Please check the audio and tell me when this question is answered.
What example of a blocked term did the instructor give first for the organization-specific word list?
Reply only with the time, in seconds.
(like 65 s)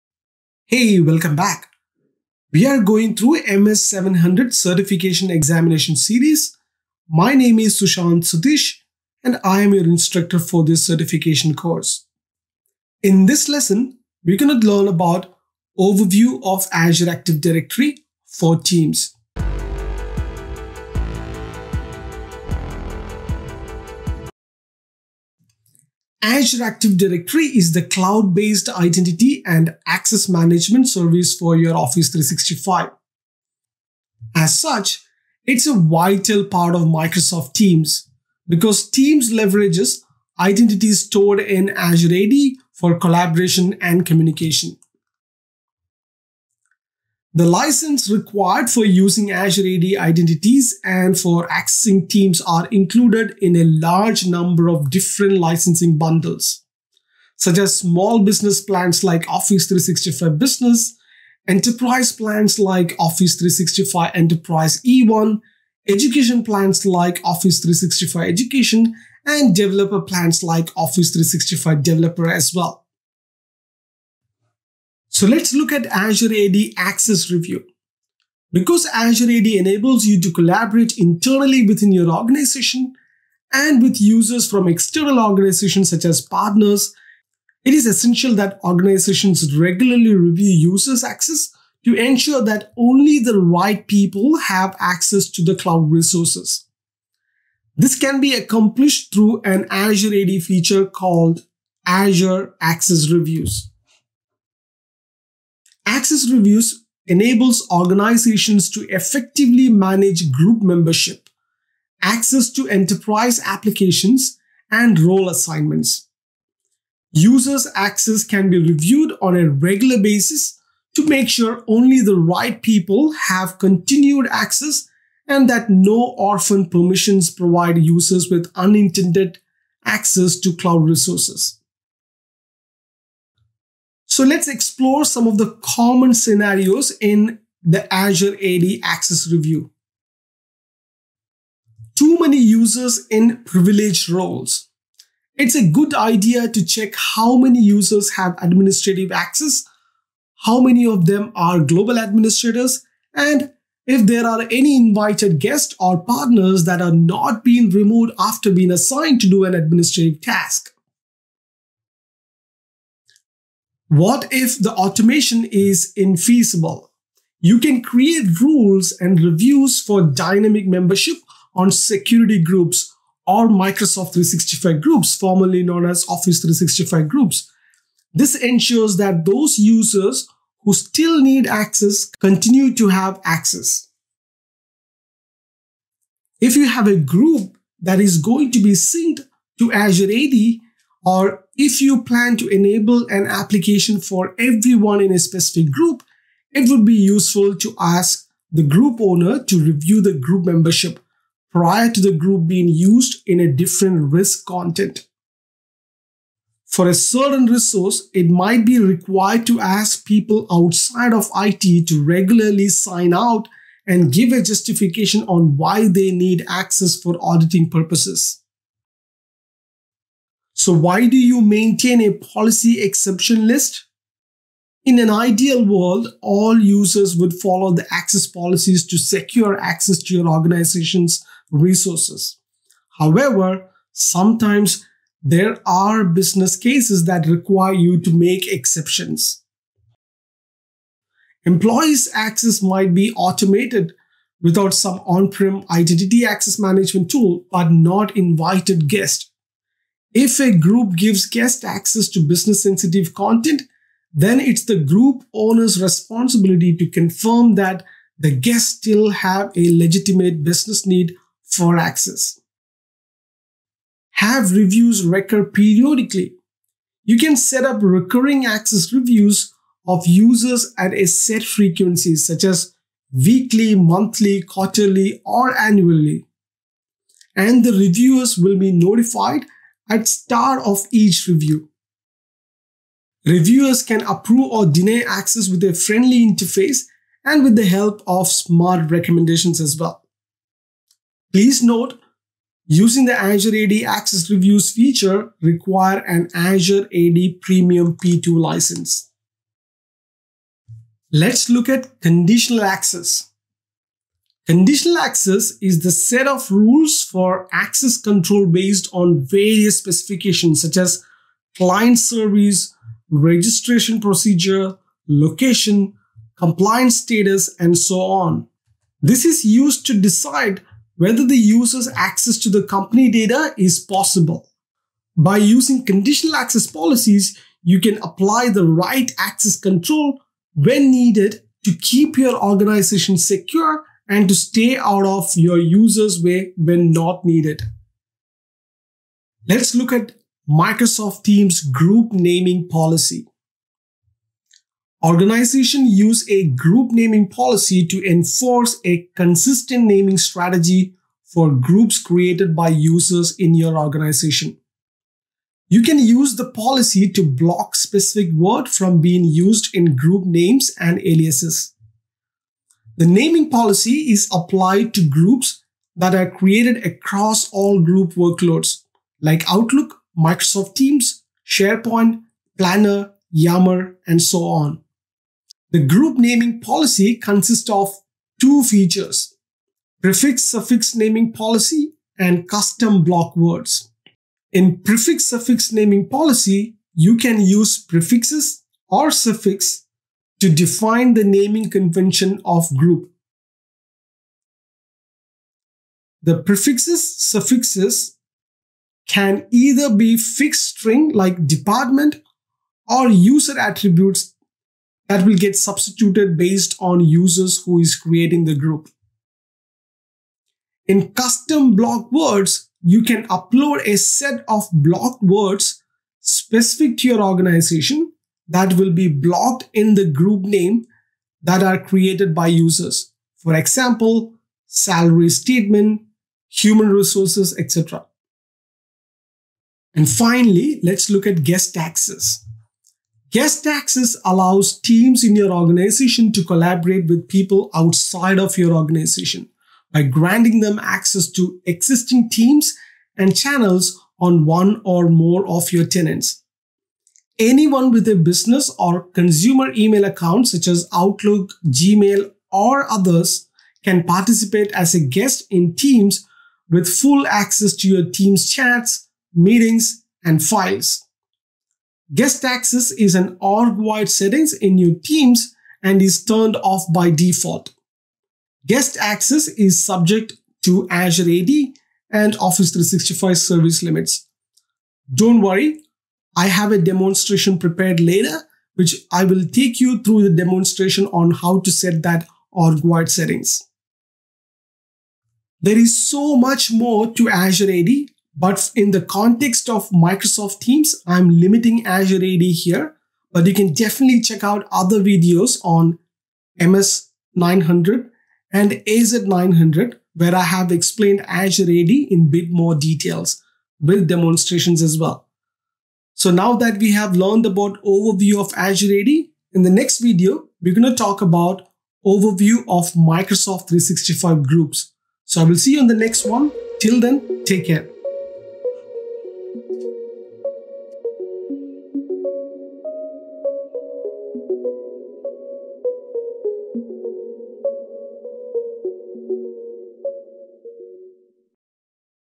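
424 s.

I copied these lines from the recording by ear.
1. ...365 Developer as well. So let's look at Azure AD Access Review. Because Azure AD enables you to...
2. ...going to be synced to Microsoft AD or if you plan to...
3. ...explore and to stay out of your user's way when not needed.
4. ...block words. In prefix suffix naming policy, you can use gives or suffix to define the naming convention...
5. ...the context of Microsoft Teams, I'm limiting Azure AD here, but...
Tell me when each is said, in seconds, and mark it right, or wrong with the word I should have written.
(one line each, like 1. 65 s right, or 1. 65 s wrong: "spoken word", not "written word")
1. 71 s right
2. 188 s wrong: "Azure", not "Microsoft"
3. 333 s wrong: "secure", not "explore"
4. 383 s wrong: "prefixes", not "gives"
5. 488 s right.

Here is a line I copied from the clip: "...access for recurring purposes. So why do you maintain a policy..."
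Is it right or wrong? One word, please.
wrong.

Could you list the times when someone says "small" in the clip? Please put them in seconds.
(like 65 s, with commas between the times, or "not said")
57 s.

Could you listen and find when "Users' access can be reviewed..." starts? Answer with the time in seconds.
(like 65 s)
117 s.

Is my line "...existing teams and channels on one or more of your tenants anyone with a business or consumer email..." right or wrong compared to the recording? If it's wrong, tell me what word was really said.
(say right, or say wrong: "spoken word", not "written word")
right.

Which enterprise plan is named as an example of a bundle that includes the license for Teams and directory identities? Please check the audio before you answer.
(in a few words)
Office 365 Enterprise E1.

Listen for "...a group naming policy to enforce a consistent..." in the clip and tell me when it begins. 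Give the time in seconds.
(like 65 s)
346 s.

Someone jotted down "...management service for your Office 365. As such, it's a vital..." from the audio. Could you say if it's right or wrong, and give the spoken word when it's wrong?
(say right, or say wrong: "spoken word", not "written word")
right.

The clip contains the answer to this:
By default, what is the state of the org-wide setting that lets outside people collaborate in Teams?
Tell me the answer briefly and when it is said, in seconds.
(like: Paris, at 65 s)
Turned off, at 466 s.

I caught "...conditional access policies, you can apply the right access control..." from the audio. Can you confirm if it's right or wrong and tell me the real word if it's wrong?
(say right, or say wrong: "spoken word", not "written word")
right.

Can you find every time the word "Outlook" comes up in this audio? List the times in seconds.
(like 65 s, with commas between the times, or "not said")
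369 s, 450 s.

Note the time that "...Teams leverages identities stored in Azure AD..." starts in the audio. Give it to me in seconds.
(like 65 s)
38 s.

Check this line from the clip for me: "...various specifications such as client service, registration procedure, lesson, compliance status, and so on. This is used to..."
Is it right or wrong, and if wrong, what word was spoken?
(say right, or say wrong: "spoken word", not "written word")
wrong: "location", not "lesson".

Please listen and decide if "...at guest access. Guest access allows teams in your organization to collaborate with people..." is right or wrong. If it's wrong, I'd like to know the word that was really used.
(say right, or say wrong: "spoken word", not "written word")
right.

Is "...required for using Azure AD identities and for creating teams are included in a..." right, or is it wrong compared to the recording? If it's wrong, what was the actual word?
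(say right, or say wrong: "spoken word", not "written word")
wrong: "accessing", not "creating".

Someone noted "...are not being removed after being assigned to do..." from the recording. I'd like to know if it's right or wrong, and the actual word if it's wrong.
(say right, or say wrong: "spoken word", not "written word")
right.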